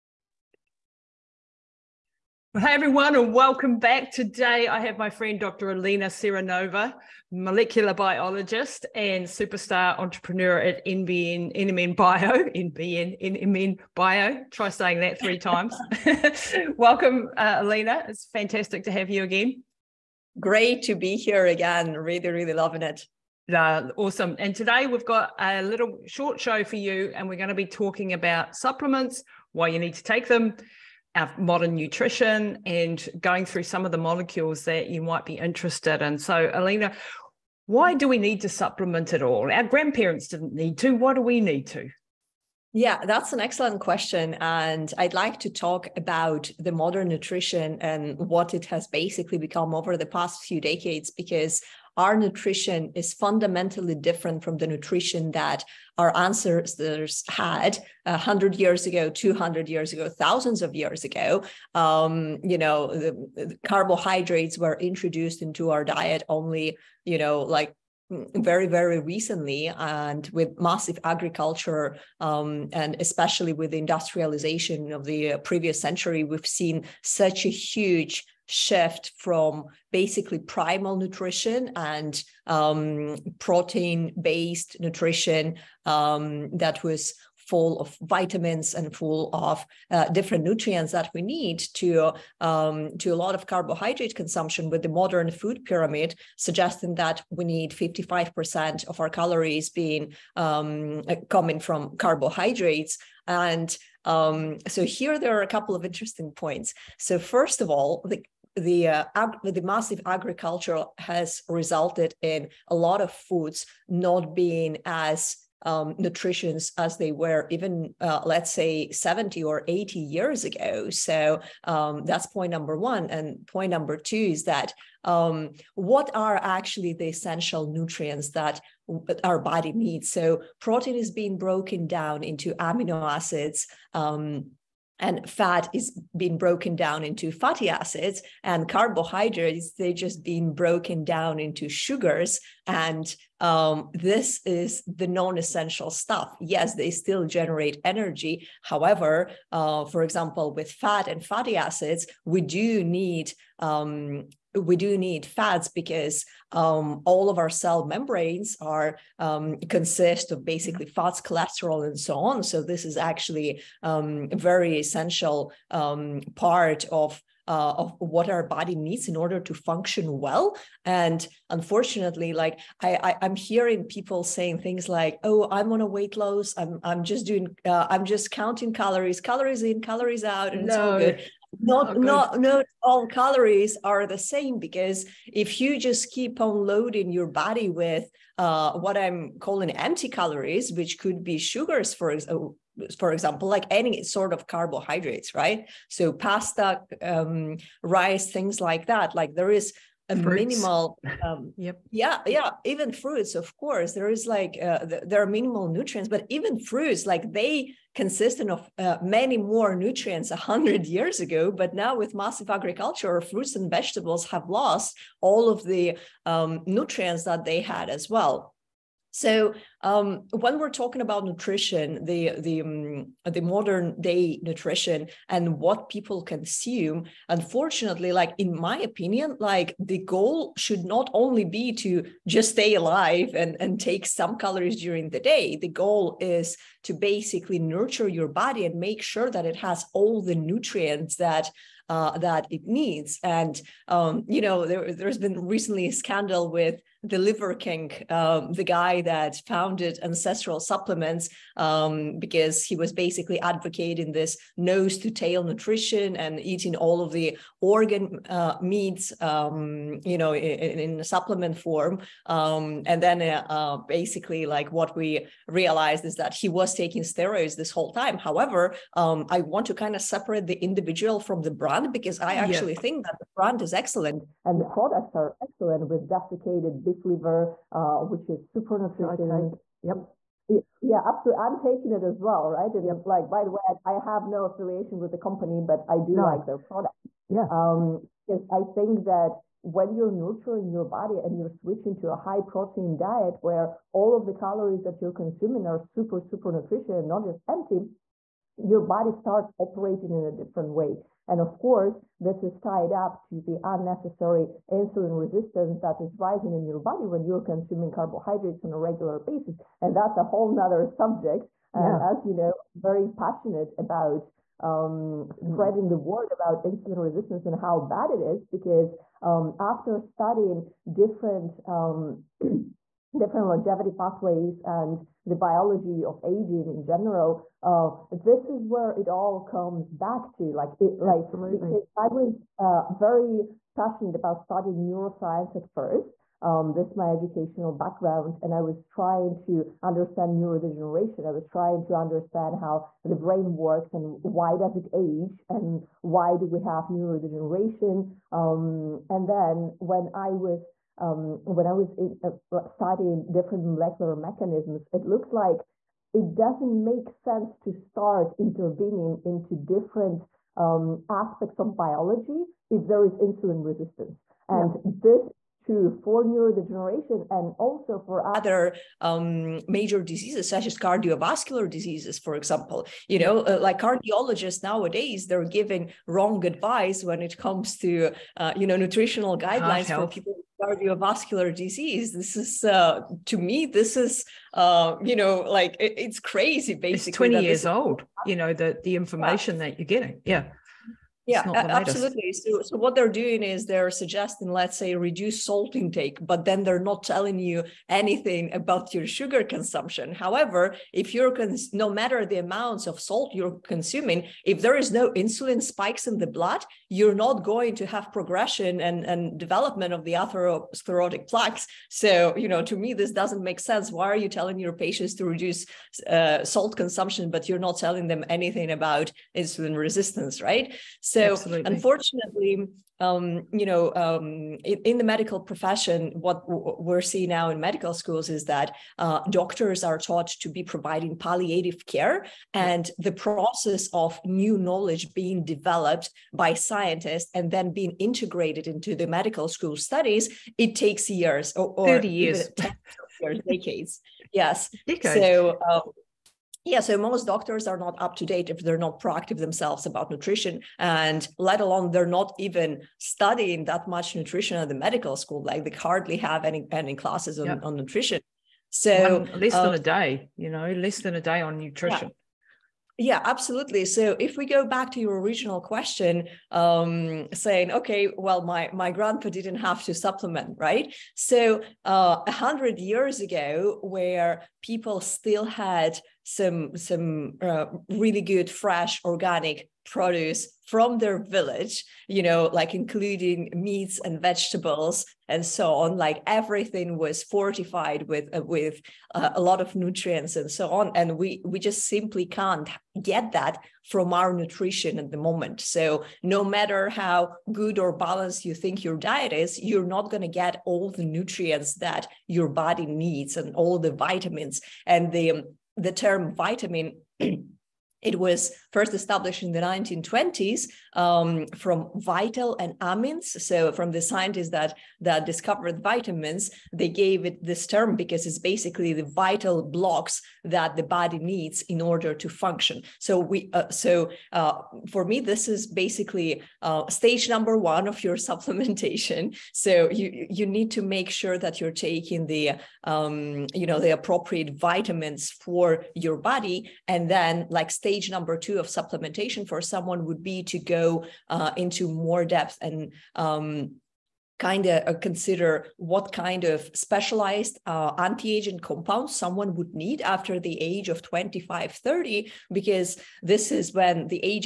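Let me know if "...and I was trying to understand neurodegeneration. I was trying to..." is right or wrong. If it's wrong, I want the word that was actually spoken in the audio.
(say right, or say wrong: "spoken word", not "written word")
right.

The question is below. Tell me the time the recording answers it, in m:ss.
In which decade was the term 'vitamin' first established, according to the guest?
8:29.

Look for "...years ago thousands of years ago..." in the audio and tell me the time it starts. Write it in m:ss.
0:59.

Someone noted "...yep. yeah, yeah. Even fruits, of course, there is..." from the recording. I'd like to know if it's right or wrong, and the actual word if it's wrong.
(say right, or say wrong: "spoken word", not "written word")
right.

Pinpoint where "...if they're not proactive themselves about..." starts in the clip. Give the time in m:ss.
7:28.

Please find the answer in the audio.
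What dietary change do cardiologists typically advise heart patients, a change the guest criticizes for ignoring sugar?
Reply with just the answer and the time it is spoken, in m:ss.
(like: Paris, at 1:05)
Reduce salt intake, at 6:34.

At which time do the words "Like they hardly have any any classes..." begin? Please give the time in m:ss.
7:35.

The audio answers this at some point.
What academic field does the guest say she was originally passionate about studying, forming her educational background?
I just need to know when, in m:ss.
5:34.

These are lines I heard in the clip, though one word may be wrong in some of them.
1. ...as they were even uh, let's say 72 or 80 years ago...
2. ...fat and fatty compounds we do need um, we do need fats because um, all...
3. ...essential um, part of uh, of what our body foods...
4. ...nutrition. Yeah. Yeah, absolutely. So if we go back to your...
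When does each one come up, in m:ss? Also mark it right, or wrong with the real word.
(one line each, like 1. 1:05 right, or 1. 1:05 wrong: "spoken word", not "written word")
1. 1:56 wrong: "70", not "72"
2. 2:30 wrong: "acids", not "compounds"
3. 2:44 wrong: "needs", not "foods"
4. 7:41 right.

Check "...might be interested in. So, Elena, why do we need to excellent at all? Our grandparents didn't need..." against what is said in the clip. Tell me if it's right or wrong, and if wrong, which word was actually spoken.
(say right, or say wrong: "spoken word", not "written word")
wrong: "supplement", not "excellent".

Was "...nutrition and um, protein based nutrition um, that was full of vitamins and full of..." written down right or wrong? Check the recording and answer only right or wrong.
right.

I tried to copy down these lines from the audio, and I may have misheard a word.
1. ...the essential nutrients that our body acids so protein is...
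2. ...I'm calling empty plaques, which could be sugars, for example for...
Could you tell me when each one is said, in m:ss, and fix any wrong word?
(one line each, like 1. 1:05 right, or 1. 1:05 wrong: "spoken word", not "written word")
1. 2:06 wrong: "needs", not "acids"
2. 3:08 wrong: "calories", not "plaques".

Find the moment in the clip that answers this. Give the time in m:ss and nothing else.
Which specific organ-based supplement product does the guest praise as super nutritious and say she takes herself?
4:36.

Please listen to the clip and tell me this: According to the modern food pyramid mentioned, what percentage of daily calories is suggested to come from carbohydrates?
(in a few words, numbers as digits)
55%.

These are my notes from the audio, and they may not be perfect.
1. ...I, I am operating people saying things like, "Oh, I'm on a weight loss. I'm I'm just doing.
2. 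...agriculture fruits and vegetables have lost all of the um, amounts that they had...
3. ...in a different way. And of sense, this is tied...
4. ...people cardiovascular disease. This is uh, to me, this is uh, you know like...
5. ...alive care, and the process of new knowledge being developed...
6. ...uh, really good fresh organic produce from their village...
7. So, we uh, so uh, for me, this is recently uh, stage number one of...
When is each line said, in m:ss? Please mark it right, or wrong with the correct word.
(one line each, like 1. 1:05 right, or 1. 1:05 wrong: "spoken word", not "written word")
1. 2:52 wrong: "hearing", not "operating"
2. 3:32 wrong: "nutrients", not "amounts"
3. 5:00 wrong: "course", not "sense"
4. 6:20 right
5. 7:11 wrong: "palliative", not "alive"
6. 7:57 right
7. 8:42 wrong: "basically", not "recently".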